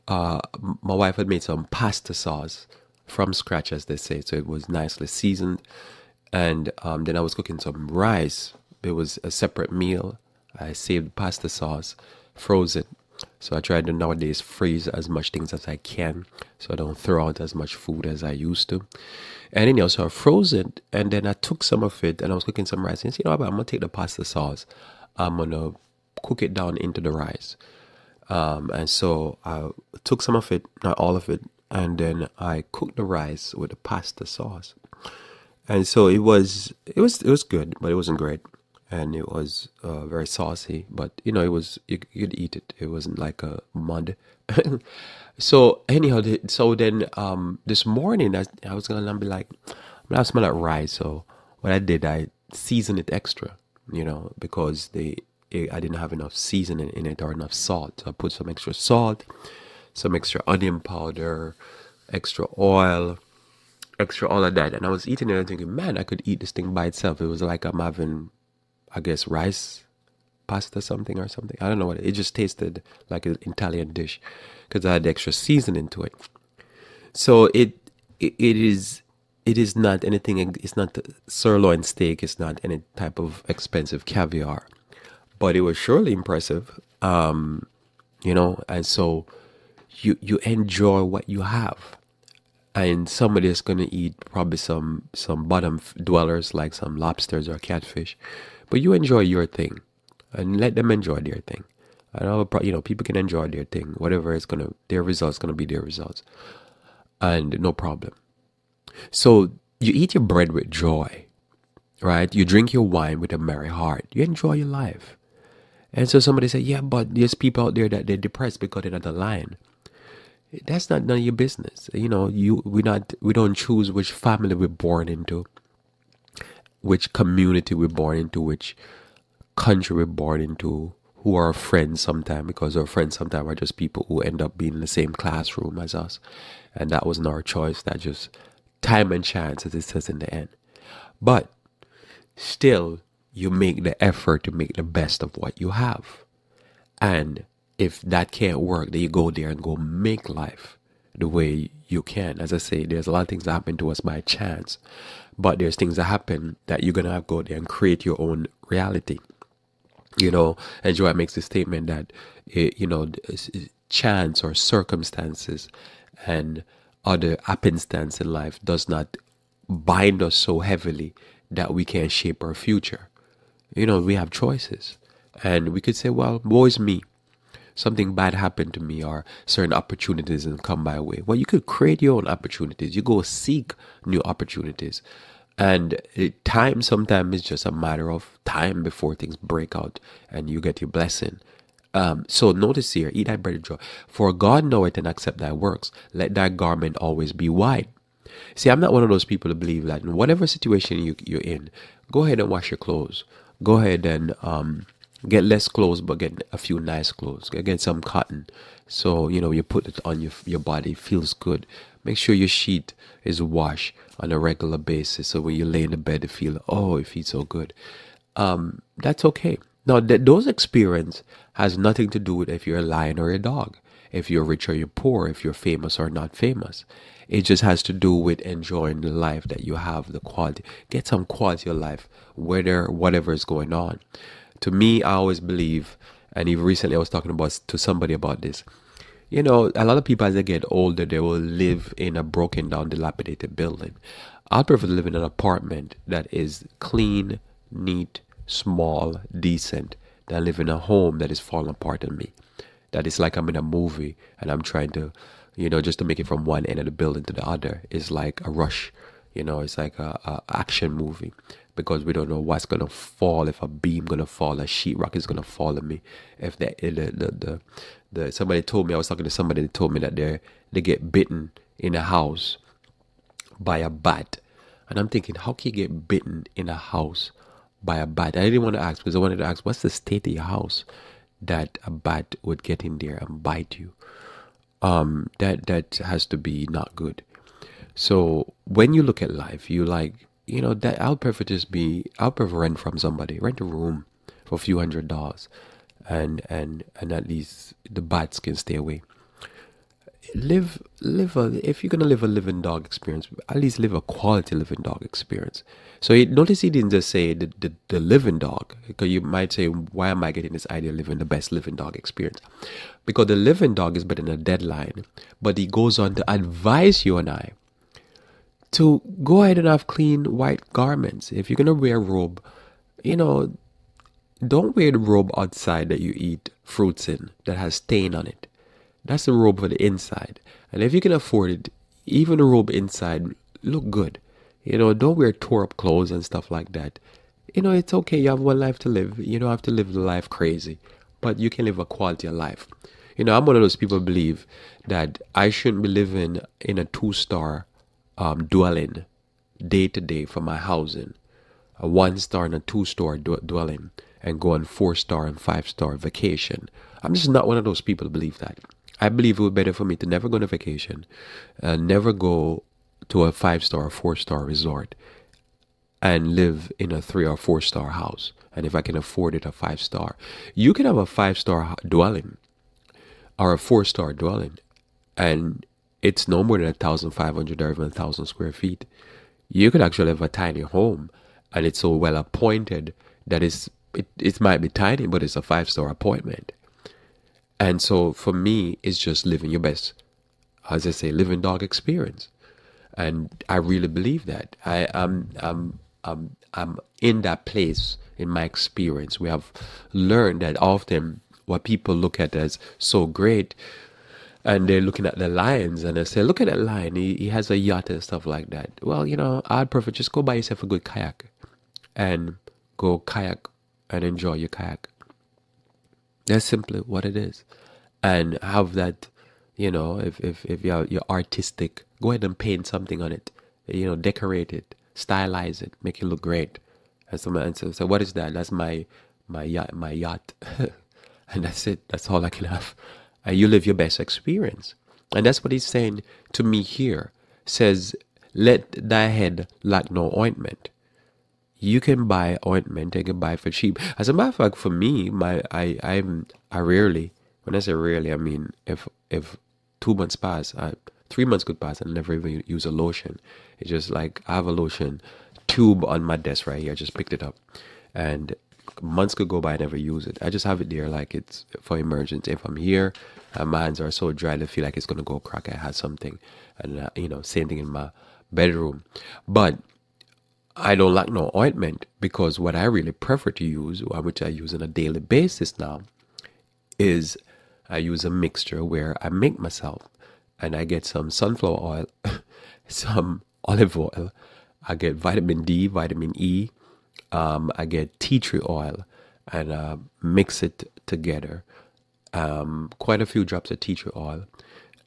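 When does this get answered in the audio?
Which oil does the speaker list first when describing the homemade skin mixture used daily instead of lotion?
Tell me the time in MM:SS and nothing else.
08:01.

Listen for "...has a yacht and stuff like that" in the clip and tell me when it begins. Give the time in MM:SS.
06:47.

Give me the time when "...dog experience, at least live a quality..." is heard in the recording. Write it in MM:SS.
05:02.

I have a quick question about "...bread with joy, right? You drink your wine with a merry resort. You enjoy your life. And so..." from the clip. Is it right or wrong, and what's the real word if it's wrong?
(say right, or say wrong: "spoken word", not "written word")
wrong: "heart", not "resort".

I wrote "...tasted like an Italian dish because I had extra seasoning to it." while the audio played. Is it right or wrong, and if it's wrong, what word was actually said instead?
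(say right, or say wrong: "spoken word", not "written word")
right.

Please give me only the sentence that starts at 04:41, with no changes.
that a bat would get in there and bite you.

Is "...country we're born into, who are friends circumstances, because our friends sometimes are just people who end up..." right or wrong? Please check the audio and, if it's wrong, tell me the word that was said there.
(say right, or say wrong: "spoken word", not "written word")
wrong: "sometimes", not "circumstances".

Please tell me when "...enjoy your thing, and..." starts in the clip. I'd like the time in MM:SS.
01:38.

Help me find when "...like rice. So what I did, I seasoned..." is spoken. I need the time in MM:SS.
00:50.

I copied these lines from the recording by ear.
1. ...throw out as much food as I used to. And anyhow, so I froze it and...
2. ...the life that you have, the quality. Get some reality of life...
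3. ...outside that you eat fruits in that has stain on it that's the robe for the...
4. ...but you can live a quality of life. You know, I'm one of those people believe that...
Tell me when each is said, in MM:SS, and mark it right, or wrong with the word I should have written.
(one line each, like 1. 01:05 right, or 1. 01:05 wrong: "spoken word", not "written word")
1. 00:16 right
2. 03:49 wrong: "quality", not "reality"
3. 05:25 right
4. 05:41 right.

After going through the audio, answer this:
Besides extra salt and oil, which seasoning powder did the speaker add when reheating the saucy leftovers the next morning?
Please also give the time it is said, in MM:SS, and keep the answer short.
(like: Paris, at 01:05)
onion powder, at 01:00.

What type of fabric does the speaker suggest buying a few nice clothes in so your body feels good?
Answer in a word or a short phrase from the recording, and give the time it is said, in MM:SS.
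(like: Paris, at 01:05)
cotton, at 03:28.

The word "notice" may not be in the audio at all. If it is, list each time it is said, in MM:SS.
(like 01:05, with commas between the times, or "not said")
03:12, 05:06.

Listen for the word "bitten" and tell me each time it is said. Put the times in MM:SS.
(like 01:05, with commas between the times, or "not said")
04:31, 04:36.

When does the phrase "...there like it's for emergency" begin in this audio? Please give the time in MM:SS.
07:40.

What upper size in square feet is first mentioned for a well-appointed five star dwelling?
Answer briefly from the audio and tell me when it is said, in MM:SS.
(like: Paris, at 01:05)
1,500, at 06:16.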